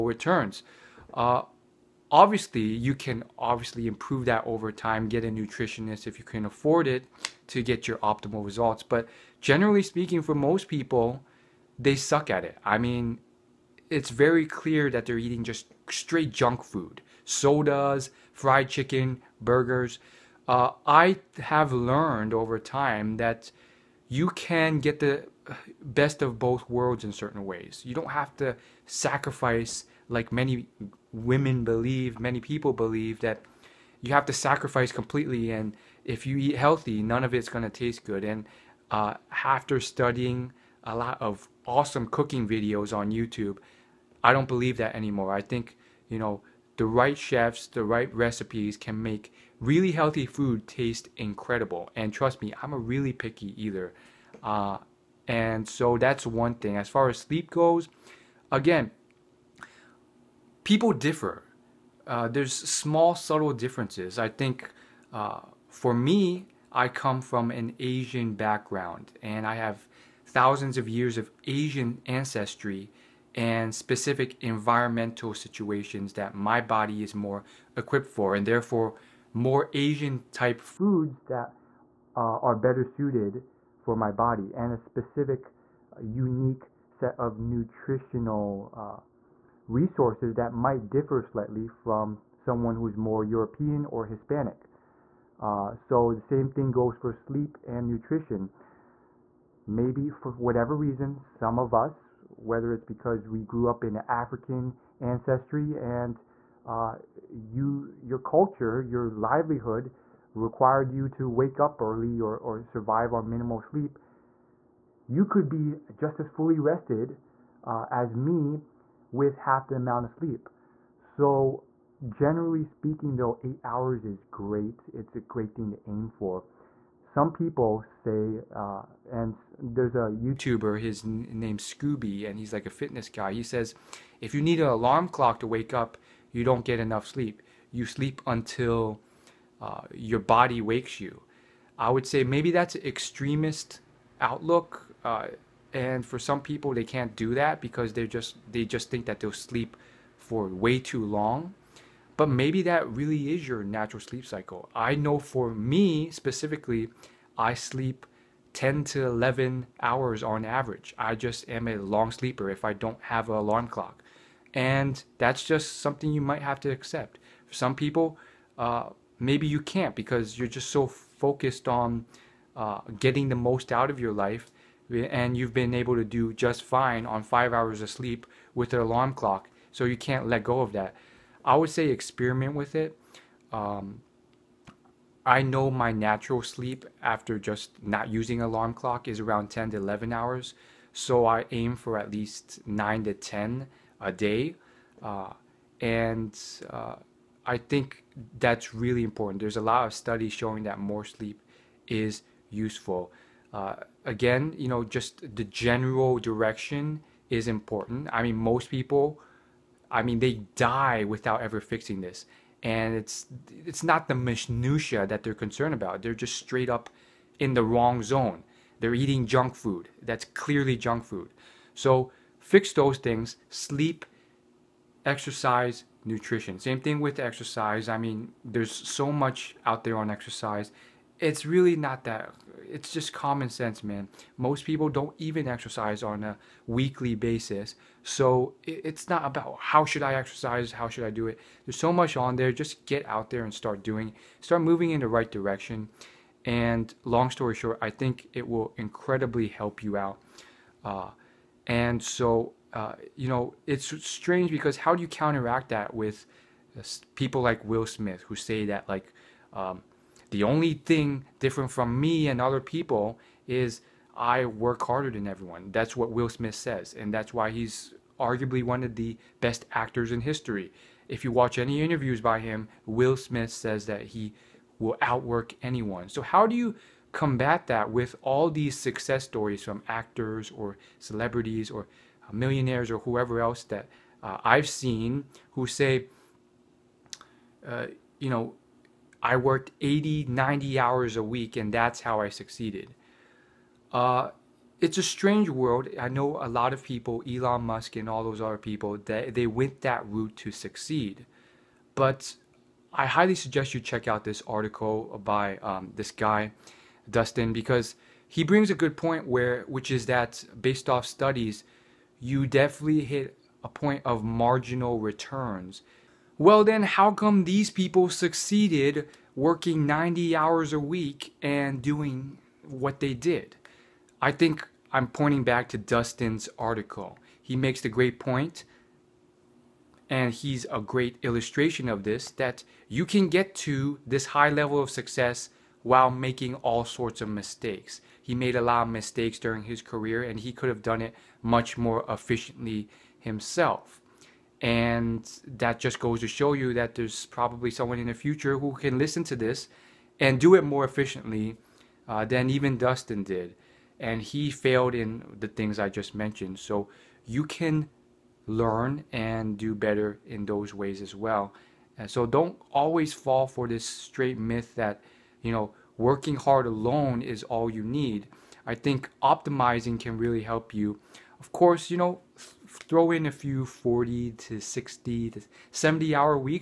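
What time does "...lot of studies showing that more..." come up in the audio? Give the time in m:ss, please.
3:19.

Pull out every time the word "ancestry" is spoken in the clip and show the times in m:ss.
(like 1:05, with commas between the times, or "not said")
1:12, 1:44.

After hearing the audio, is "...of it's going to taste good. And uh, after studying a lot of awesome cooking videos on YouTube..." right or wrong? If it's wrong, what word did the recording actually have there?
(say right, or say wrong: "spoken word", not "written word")
right.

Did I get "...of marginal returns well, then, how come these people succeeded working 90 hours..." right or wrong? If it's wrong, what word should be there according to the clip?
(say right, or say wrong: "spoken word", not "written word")
right.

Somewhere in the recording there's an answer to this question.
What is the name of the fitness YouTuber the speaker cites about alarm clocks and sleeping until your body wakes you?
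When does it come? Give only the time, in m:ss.
2:11.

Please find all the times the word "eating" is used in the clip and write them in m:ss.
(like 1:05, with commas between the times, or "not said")
0:15, 3:38.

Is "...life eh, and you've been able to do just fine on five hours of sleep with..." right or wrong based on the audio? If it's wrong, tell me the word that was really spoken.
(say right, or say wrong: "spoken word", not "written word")
right.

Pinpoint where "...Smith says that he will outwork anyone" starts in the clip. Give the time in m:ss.
4:33.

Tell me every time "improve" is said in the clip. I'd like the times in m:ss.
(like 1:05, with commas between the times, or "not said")
0:03.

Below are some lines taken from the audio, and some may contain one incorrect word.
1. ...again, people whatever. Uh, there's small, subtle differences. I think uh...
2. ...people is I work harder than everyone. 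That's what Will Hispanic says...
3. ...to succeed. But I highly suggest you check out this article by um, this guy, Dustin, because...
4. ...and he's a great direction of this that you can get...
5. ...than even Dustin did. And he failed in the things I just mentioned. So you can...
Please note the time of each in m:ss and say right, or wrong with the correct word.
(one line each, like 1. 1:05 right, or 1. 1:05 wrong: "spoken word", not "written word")
1. 0:58 wrong: "differ", not "whatever"
2. 4:22 wrong: "Smith", not "Hispanic"
3. 5:00 right
4. 5:30 wrong: "illustration", not "direction"
5. 5:52 right.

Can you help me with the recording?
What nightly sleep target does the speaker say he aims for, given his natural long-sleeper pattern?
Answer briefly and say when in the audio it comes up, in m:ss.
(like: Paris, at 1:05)
9 to 10, at 3:12.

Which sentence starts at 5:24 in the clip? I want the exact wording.
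I think I'm pointing back to Dustin's article.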